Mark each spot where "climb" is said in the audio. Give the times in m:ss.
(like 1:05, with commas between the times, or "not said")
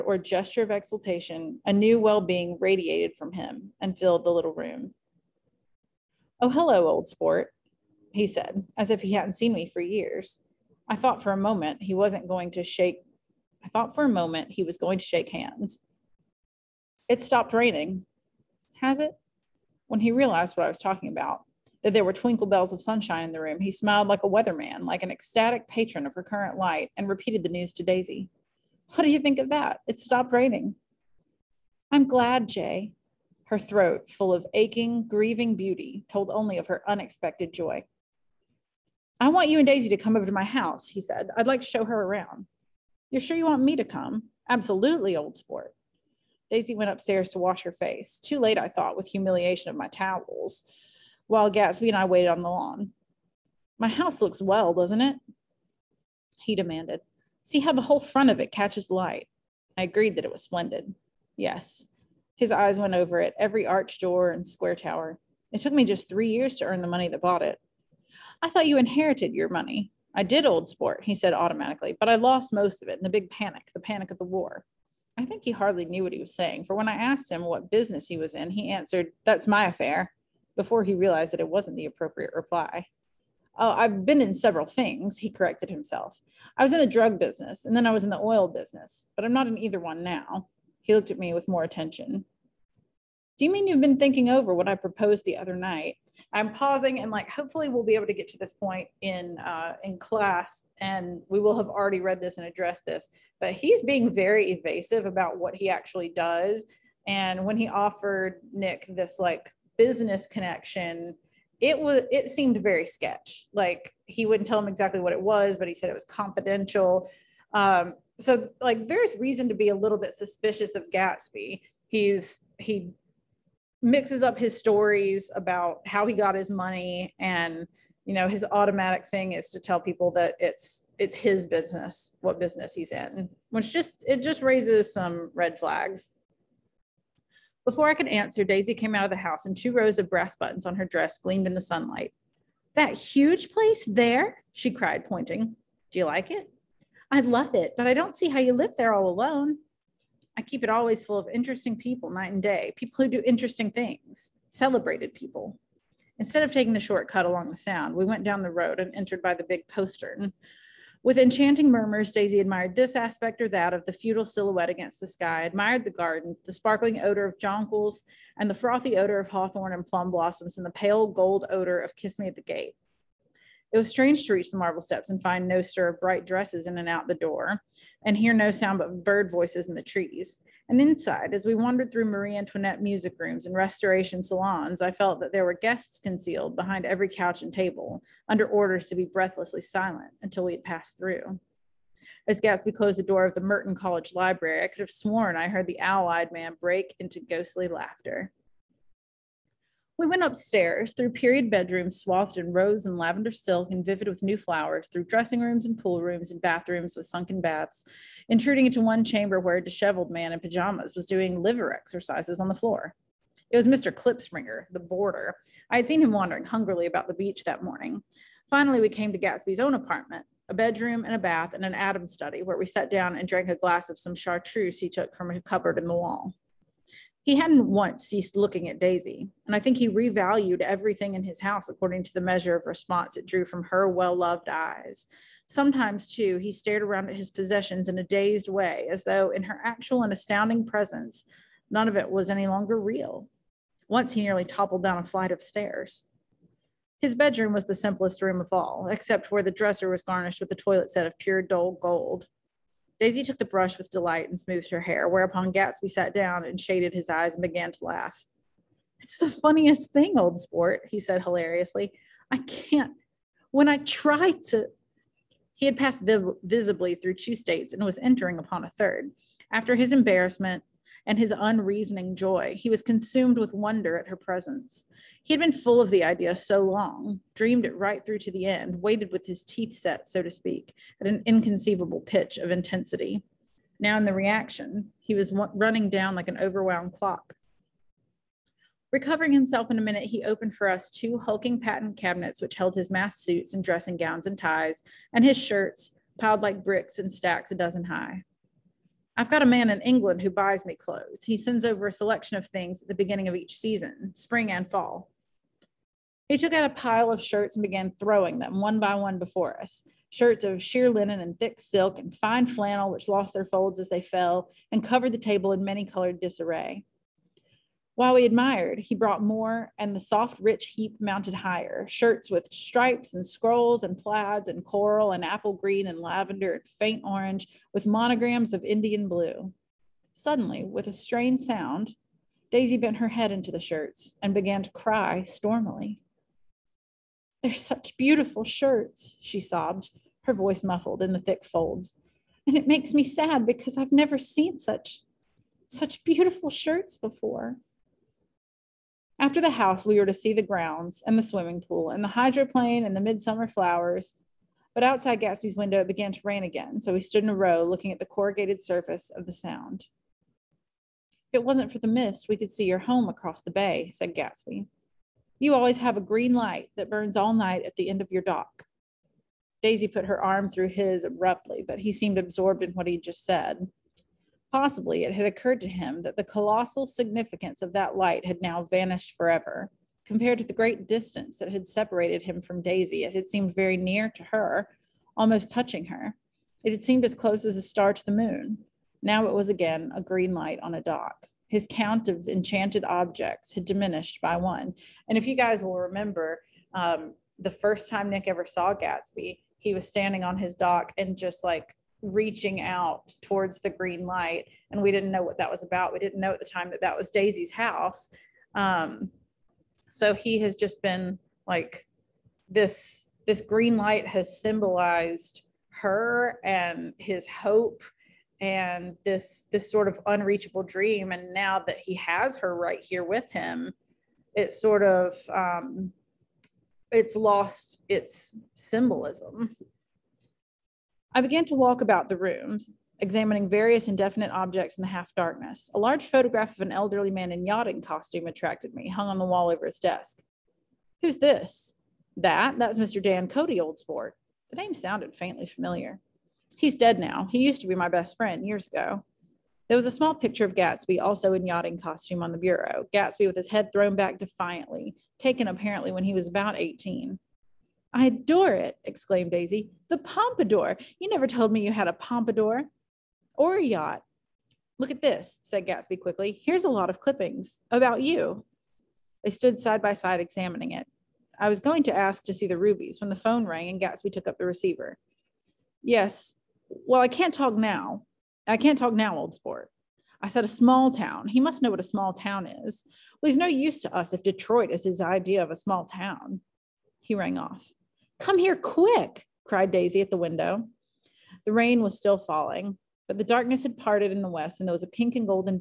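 not said.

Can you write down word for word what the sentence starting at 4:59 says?
I've got a man in England who buys me clothes.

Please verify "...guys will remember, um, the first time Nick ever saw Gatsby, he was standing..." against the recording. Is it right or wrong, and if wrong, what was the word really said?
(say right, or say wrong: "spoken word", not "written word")
right.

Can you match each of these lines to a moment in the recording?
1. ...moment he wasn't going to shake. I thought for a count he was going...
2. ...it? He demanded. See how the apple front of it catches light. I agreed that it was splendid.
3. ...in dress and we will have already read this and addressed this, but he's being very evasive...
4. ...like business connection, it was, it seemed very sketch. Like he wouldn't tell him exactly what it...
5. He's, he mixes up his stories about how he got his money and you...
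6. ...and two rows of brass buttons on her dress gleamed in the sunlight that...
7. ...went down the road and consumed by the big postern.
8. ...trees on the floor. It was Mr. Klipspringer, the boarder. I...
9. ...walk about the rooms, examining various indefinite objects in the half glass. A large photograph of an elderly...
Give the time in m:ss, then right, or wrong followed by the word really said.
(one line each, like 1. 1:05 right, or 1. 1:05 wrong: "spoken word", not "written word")
1. 0:11 wrong: "moment", not "count"
2. 0:54 wrong: "whole", not "apple"
3. 1:39 wrong: "class", not "dress"
4. 1:49 right
5. 2:01 right
6. 2:19 right
7. 2:38 wrong: "entered", not "consumed"
8. 3:31 wrong: "exercises", not "trees"
9. 7:11 wrong: "darkness", not "glass".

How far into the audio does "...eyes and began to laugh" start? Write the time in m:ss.
4:17.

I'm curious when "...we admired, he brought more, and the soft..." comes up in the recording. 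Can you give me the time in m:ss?
5:18.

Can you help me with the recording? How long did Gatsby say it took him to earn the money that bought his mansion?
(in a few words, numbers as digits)
3 years.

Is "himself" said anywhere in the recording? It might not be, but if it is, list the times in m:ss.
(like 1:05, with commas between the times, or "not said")
1:25, 4:49.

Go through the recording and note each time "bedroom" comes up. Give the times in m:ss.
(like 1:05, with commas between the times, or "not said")
3:21, 3:40, 4:07.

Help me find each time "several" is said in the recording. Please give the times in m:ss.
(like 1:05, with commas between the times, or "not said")
1:24.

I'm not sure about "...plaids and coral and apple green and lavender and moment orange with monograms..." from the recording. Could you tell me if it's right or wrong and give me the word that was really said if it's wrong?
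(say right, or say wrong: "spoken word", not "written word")
wrong: "faint", not "moment".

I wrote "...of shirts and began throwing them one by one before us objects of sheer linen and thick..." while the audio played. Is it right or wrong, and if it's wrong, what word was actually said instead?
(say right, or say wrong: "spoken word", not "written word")
wrong: "shirts", not "objects".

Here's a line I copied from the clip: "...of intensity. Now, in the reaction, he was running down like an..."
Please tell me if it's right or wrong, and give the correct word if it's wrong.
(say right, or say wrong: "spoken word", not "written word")
right.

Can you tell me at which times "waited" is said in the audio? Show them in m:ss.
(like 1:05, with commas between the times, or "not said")
0:52, 4:38.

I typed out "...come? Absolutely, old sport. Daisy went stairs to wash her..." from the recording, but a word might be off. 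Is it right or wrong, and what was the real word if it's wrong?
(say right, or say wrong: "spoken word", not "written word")
wrong: "upstairs", not "stairs".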